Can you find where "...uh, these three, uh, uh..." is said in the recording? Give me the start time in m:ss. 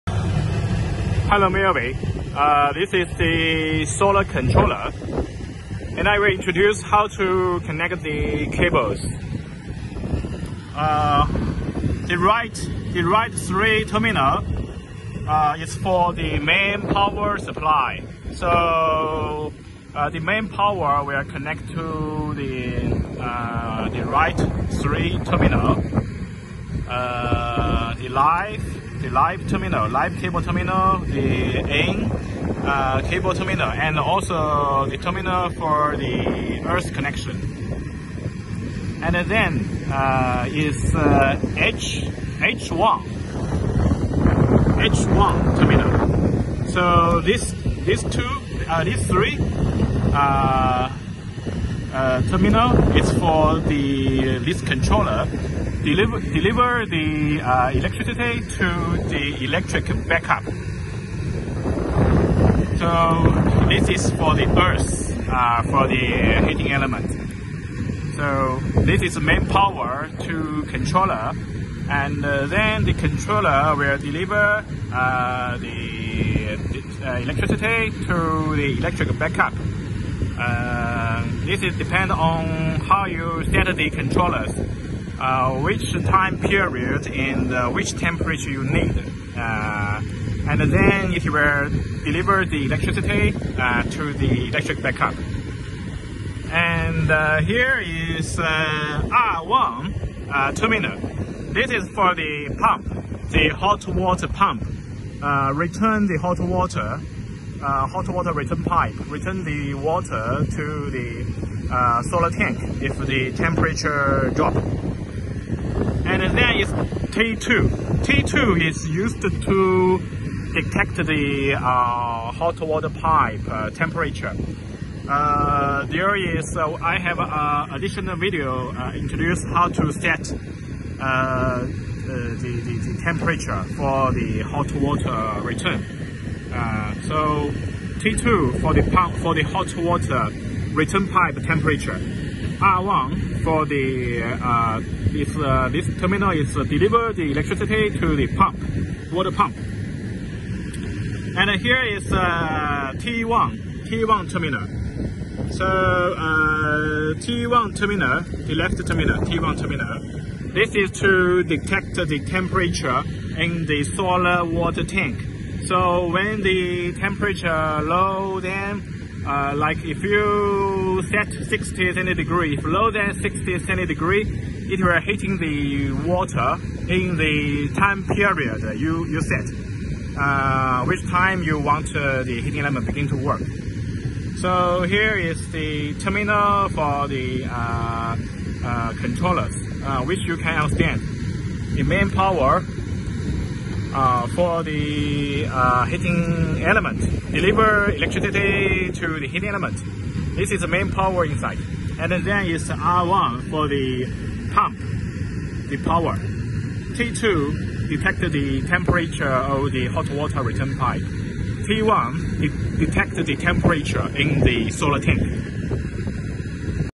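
0:48.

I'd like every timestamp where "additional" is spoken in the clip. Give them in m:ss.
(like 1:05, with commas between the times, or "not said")
2:07.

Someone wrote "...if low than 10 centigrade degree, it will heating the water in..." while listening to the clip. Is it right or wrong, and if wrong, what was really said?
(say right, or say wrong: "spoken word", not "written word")
wrong: "60", not "10".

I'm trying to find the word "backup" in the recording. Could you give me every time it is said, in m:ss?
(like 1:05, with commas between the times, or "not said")
1:00, 1:19, 1:34.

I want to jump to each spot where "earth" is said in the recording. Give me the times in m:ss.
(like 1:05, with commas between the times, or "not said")
0:36, 1:04.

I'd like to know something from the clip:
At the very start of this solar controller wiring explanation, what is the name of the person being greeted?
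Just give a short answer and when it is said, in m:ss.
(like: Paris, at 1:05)
Mary, at 0:01.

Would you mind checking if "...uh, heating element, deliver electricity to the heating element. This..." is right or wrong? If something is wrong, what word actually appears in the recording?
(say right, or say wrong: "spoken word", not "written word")
right.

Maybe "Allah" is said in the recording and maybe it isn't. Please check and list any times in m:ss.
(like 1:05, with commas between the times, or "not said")
not said.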